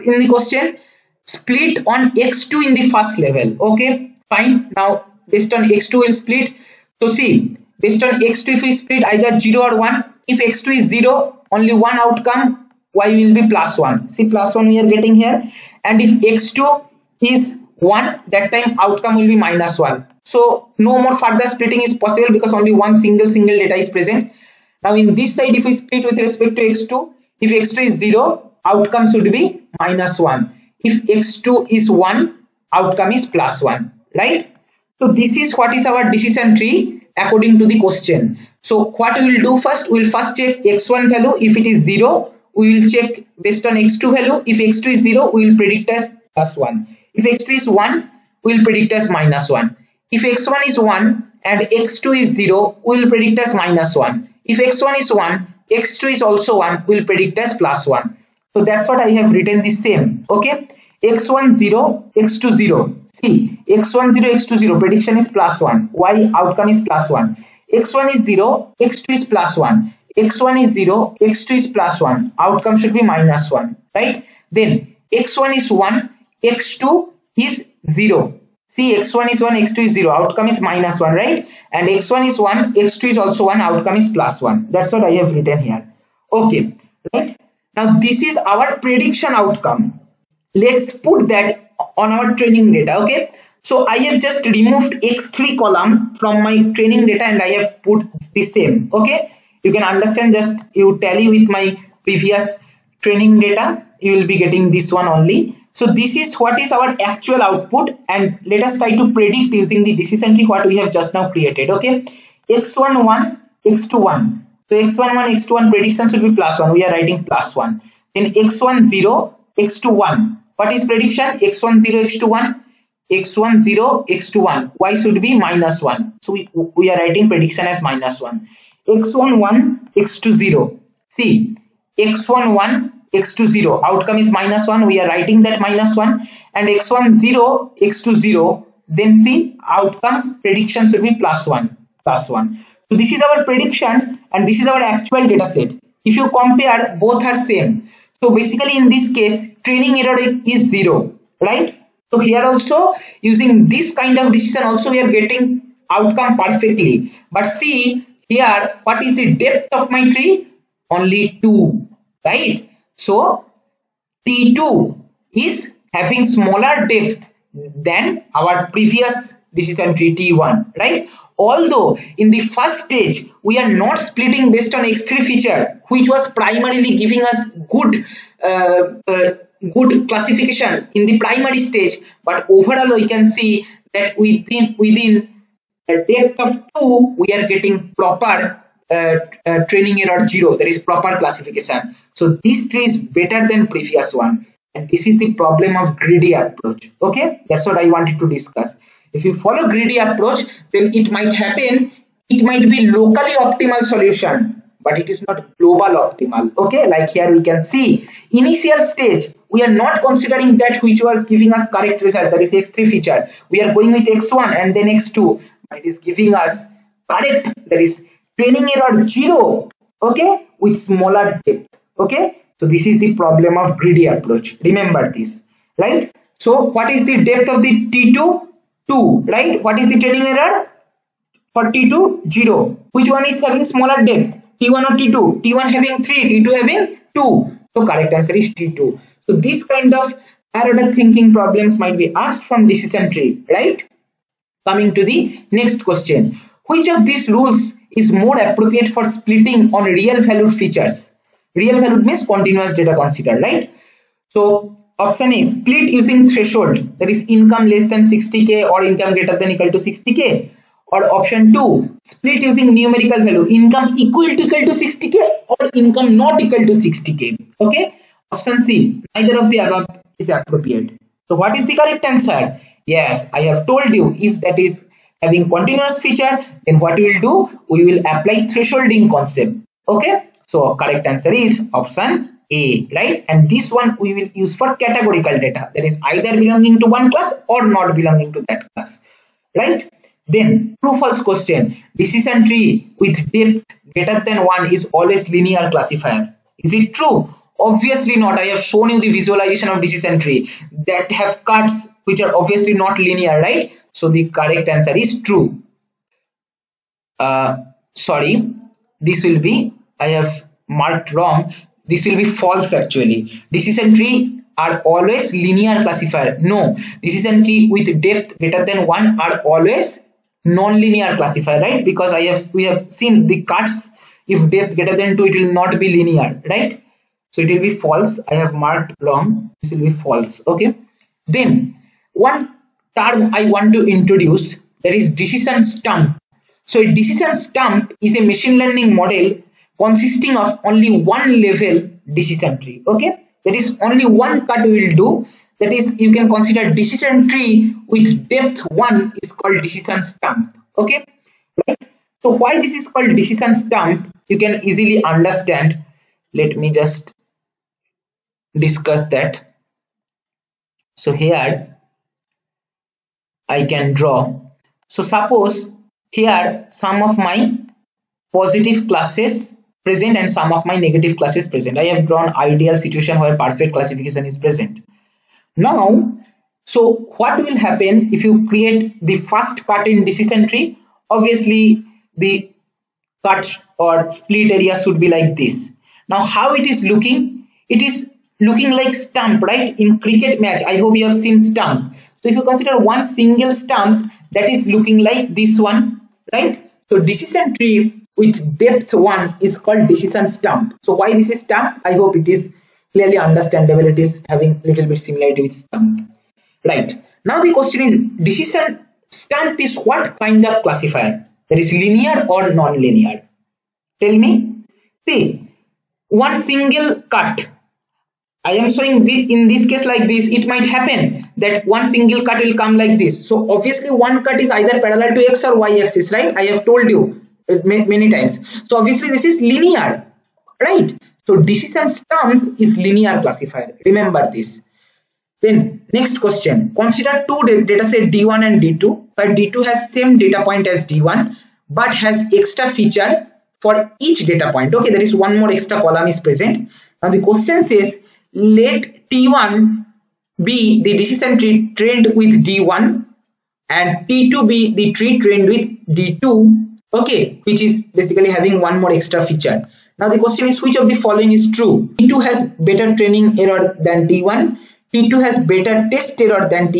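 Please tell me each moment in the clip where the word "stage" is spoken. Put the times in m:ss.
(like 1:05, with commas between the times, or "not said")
2:52, 3:01, 3:28.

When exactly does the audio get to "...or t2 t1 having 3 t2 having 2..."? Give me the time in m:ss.
3:54.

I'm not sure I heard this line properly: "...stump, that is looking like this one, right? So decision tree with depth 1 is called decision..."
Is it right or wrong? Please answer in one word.
right.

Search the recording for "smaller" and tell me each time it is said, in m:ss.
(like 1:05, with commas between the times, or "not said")
2:46, 3:40, 3:53.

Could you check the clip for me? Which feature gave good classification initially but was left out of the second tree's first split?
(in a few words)
X3.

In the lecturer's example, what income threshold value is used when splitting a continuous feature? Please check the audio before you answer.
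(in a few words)
60k.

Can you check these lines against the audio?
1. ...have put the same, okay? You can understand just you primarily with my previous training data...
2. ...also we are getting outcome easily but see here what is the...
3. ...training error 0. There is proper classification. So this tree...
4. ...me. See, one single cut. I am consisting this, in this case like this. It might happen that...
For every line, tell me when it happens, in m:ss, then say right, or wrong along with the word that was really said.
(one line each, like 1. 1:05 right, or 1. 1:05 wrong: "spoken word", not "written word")
1. 1:37 wrong: "tally", not "primarily"
2. 2:34 wrong: "perfectly", not "easily"
3. 3:09 right
4. 6:54 wrong: "showing", not "consisting".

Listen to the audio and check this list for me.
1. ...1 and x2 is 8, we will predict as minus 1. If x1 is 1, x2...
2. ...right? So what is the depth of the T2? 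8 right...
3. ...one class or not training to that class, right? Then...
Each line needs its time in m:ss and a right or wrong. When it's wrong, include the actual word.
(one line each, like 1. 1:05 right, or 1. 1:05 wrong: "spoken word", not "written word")
1. 0:50 wrong: "0", not "8"
2. 3:45 wrong: "2", not "8"
3. 4:46 wrong: "belonging", not "training".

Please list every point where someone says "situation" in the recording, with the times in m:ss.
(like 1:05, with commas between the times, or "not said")
6:12.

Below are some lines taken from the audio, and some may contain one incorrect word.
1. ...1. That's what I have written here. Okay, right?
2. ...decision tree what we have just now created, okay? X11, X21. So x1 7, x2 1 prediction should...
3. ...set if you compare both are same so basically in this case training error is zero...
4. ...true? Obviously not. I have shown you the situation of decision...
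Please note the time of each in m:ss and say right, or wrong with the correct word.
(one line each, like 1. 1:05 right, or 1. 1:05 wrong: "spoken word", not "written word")
1. 1:24 right
2. 1:49 wrong: "1", not "7"
3. 2:25 right
4. 4:56 wrong: "visualization", not "situation".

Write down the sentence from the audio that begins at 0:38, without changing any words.
So what we will do first, we will first check x1 value.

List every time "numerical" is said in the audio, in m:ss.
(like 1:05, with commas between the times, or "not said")
4:22.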